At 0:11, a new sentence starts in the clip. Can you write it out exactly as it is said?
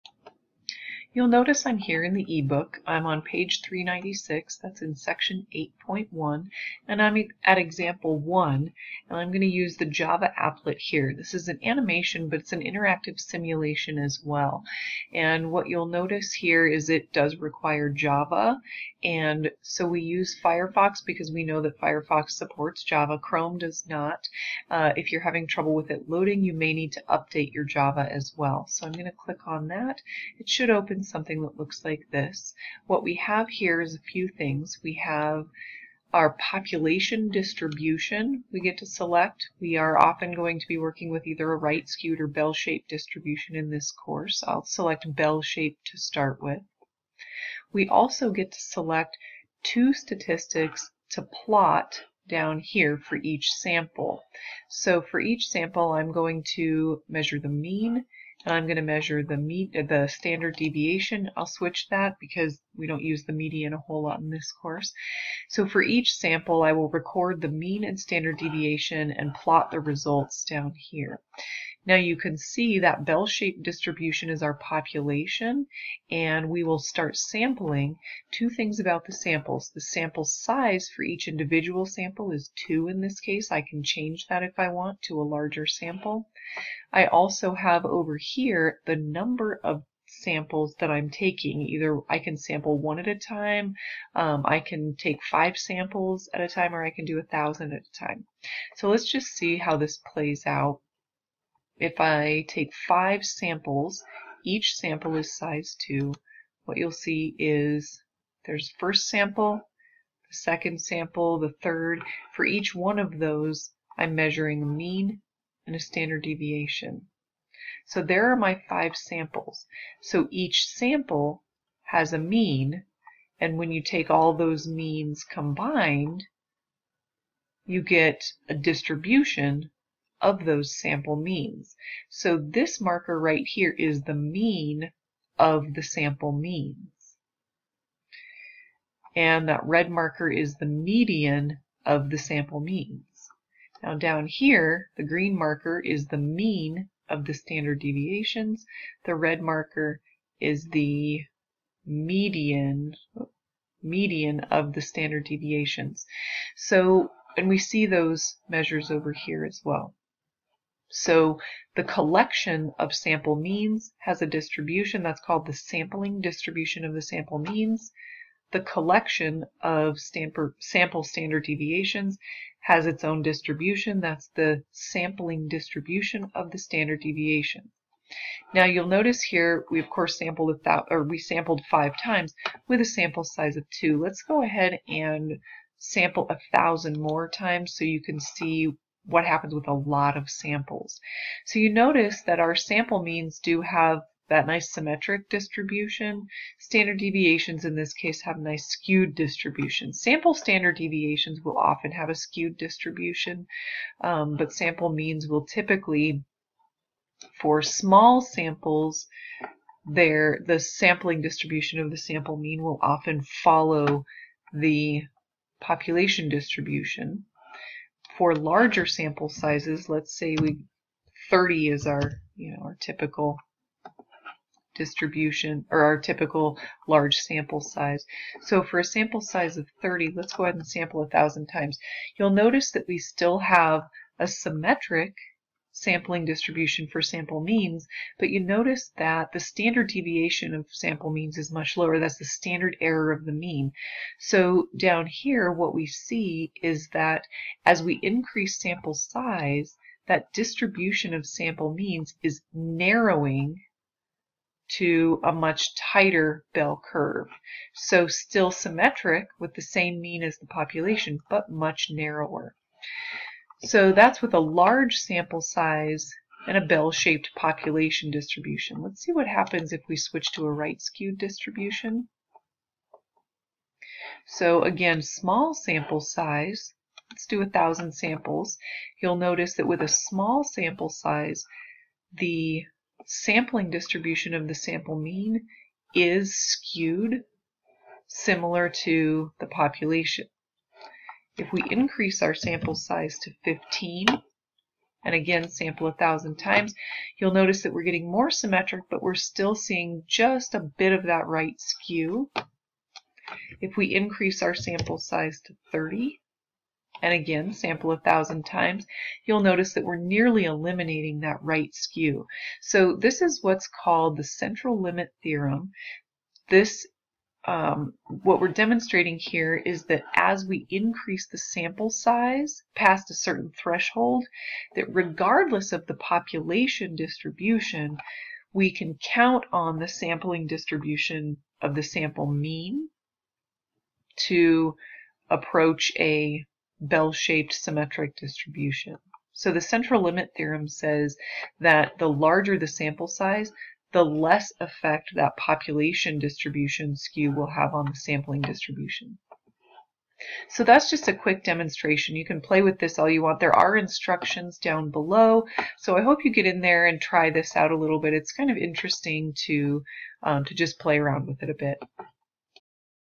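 This is an animation, but it's an interactive simulation as well.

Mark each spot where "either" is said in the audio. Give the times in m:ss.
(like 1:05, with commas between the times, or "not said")
0:41, 1:31.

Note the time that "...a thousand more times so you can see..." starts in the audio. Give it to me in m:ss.
3:06.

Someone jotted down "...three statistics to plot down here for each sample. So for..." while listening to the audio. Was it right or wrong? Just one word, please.
wrong.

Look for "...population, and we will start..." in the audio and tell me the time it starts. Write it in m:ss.
1:14.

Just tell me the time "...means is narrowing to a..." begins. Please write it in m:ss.
4:11.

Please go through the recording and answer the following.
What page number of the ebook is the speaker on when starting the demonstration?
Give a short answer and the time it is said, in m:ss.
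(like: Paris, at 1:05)
396, at 0:03.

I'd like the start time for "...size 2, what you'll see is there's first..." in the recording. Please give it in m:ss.
1:45.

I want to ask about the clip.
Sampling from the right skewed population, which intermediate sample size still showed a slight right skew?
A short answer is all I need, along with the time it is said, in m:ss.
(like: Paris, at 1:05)
15, at 4:53.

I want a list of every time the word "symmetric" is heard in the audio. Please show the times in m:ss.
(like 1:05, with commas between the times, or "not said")
3:14, 3:54, 4:18, 4:58, 5:37.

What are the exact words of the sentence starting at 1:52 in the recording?
For each one of those, I'm measuring a mean and a standard deviation.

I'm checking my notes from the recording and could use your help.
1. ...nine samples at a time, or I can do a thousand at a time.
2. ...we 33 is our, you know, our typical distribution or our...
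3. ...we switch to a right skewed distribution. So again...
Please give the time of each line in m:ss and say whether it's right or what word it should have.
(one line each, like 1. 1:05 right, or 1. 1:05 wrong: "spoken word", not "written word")
1. 1:35 wrong: "five", not "nine"
2. 3:40 wrong: "30", not "33"
3. 4:29 right.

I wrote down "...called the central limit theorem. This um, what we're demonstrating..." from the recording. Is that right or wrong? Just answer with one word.
right.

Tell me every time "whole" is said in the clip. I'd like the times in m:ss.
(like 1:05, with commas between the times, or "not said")
1:03.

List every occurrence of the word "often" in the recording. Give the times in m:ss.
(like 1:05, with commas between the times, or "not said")
0:39, 3:21, 3:32.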